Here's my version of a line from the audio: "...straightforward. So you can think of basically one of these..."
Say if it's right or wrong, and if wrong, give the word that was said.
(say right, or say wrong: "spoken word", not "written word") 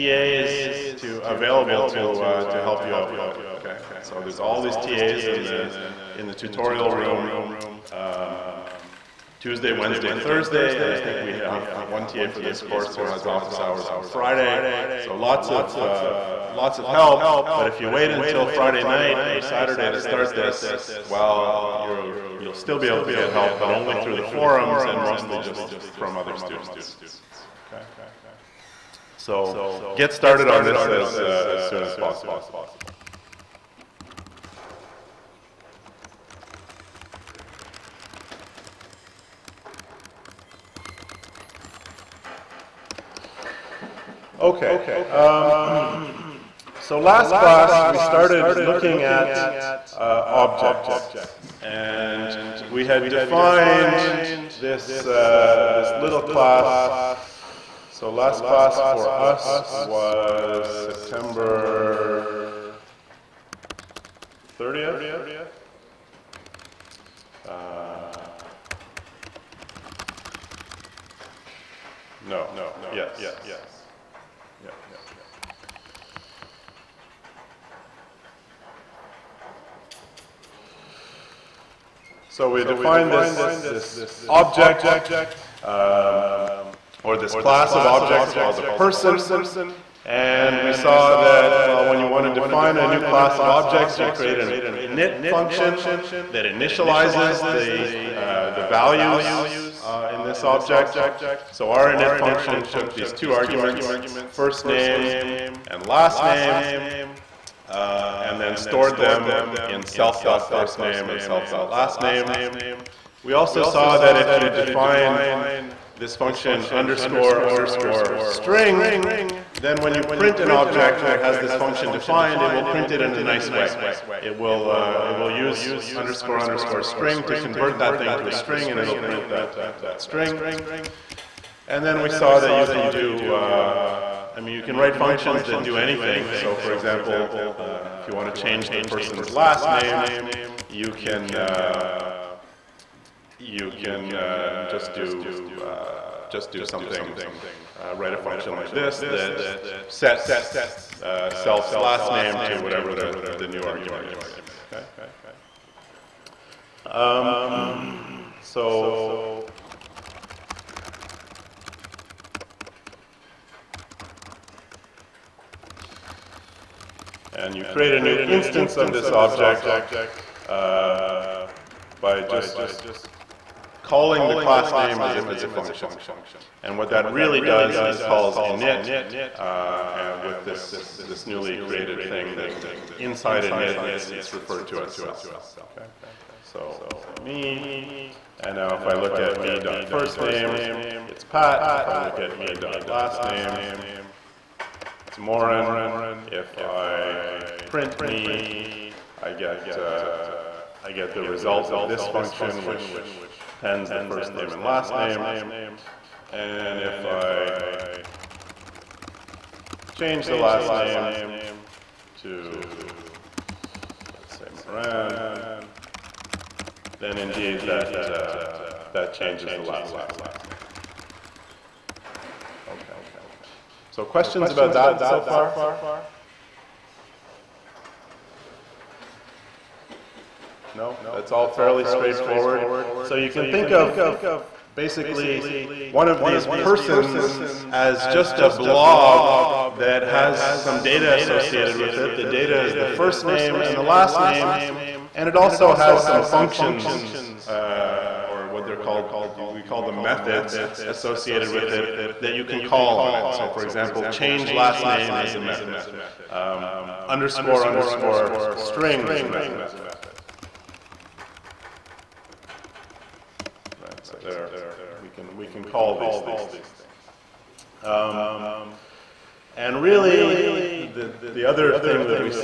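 right.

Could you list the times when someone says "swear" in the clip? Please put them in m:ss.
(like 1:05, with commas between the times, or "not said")
not said.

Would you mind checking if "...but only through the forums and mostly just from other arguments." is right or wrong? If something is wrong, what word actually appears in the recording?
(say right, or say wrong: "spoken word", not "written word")
wrong: "students", not "arguments".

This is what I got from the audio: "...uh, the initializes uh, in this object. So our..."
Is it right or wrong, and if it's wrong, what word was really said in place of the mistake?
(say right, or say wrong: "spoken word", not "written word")
wrong: "values", not "initializes".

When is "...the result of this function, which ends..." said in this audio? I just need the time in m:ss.
3:21.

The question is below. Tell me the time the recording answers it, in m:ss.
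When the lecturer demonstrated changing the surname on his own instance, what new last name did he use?
3:34.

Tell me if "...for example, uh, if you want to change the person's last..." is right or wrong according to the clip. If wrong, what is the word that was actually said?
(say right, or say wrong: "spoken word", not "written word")
right.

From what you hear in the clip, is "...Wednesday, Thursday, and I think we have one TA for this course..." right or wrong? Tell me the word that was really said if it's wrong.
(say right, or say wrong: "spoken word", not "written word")
right.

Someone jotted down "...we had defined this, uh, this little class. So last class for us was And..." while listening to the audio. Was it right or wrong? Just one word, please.
wrong.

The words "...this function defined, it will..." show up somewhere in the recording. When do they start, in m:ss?
2:01.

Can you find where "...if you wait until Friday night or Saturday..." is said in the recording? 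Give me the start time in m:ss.
0:17.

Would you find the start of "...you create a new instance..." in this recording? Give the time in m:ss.
2:47.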